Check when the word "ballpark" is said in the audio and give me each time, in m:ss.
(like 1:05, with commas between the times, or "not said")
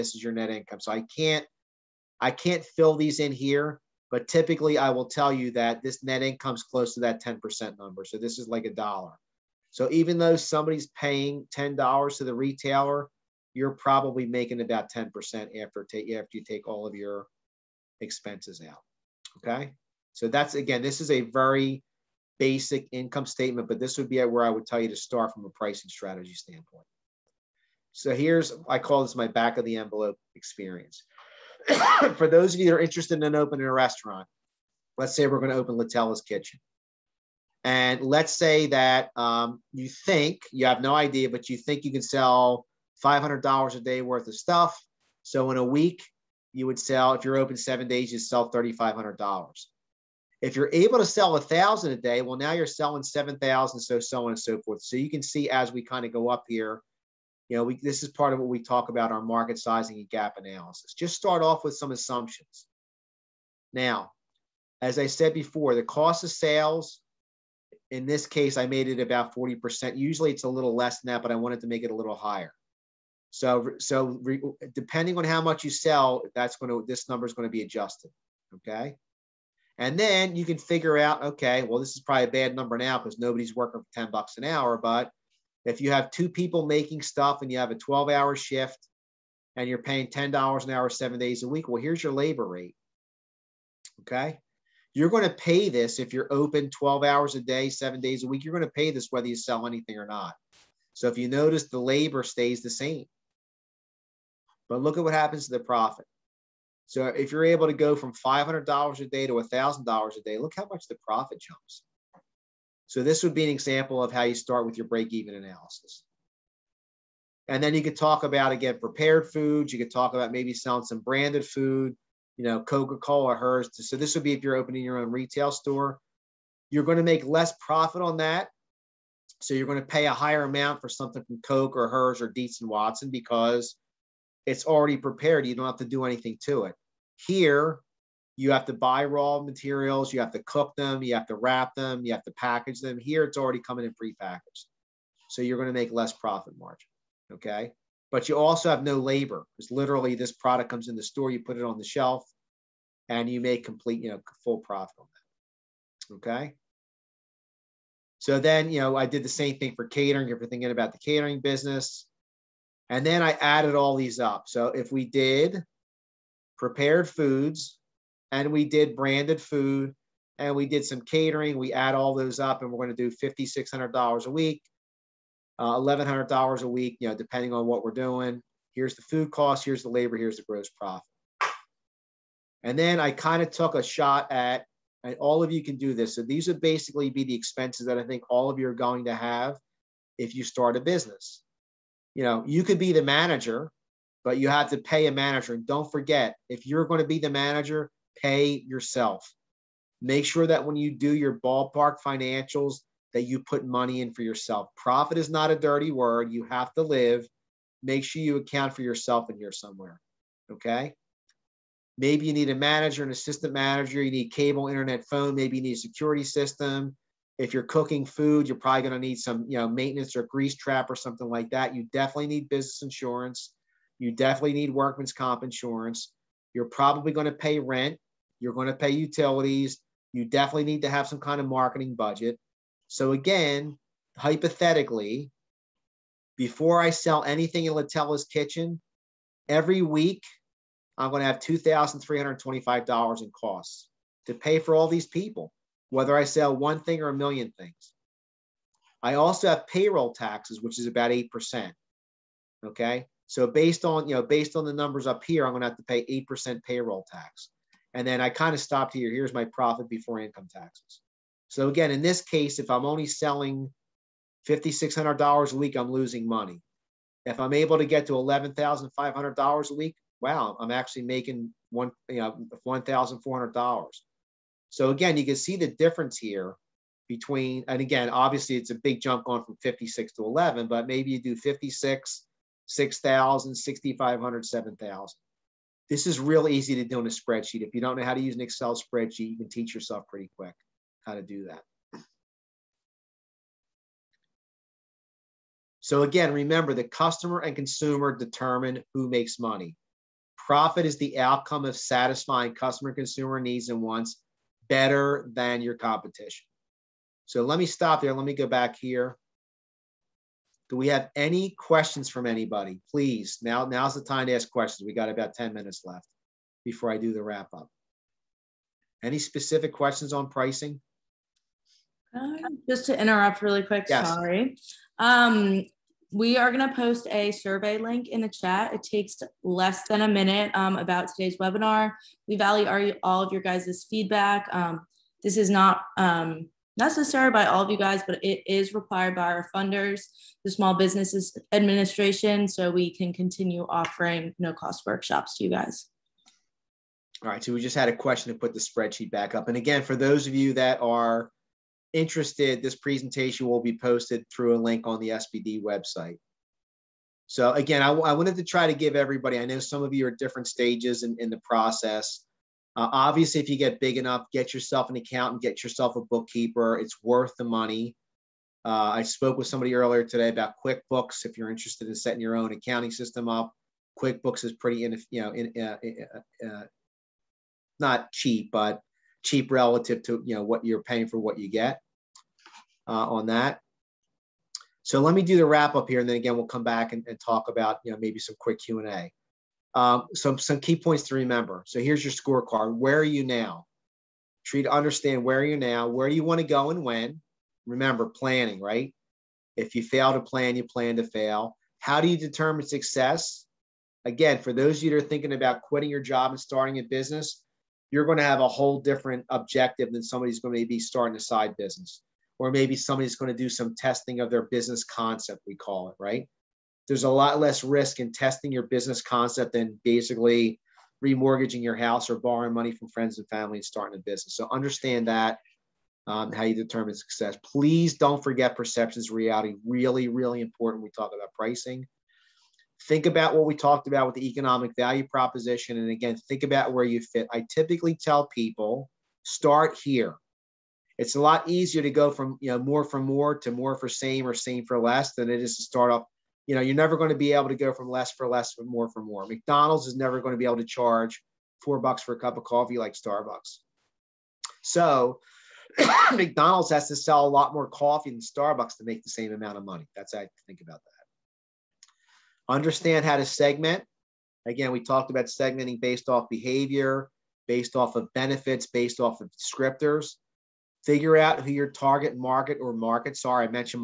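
3:21.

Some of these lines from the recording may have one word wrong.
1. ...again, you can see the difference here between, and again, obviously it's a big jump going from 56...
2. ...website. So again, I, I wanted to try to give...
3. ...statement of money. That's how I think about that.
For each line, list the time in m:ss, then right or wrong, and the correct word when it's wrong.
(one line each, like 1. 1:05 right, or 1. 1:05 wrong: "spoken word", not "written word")
1. 4:34 right
2. 5:55 right
3. 7:39 wrong: "amount", not "statement".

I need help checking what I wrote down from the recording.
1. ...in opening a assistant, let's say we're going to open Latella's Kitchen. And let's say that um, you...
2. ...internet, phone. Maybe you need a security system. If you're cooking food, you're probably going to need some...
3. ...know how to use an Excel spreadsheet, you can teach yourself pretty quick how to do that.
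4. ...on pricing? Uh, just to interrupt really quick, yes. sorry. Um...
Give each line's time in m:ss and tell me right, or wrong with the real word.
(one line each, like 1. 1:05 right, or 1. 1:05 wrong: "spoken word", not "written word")
1. 0:33 wrong: "restaurant", not "assistant"
2. 3:34 right
3. 4:47 right
4. 5:20 right.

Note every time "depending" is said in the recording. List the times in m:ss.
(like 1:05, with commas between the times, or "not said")
1:14, 2:57.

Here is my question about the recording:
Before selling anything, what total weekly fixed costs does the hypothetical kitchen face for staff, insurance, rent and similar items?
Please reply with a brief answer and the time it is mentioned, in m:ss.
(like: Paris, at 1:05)
$2,325, at 4:01.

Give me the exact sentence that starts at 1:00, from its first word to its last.
Just start off with some assumptions.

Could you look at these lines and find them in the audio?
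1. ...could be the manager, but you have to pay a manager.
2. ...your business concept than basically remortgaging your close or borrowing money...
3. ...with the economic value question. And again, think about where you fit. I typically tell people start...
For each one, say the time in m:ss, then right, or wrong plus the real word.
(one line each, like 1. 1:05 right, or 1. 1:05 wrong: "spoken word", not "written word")
1. 3:12 right
2. 6:58 wrong: "house", not "close"
3. 7:14 wrong: "proposition", not "question".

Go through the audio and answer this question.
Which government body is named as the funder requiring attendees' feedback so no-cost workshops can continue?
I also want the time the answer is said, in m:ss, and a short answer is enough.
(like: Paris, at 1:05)
Small Businesses Administration, at 5:40.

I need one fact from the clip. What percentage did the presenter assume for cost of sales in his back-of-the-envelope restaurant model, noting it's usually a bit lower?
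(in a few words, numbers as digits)
40%.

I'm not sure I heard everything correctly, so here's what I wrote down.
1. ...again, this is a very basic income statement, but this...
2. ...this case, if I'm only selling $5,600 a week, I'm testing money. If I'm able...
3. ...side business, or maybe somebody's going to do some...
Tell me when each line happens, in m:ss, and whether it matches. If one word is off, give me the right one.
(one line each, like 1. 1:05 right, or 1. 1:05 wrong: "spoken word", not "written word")
1. 0:20 right
2. 4:22 wrong: "losing", not "testing"
3. 6:51 right.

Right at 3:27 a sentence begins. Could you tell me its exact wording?
Make sure you account for yourself in here somewhere.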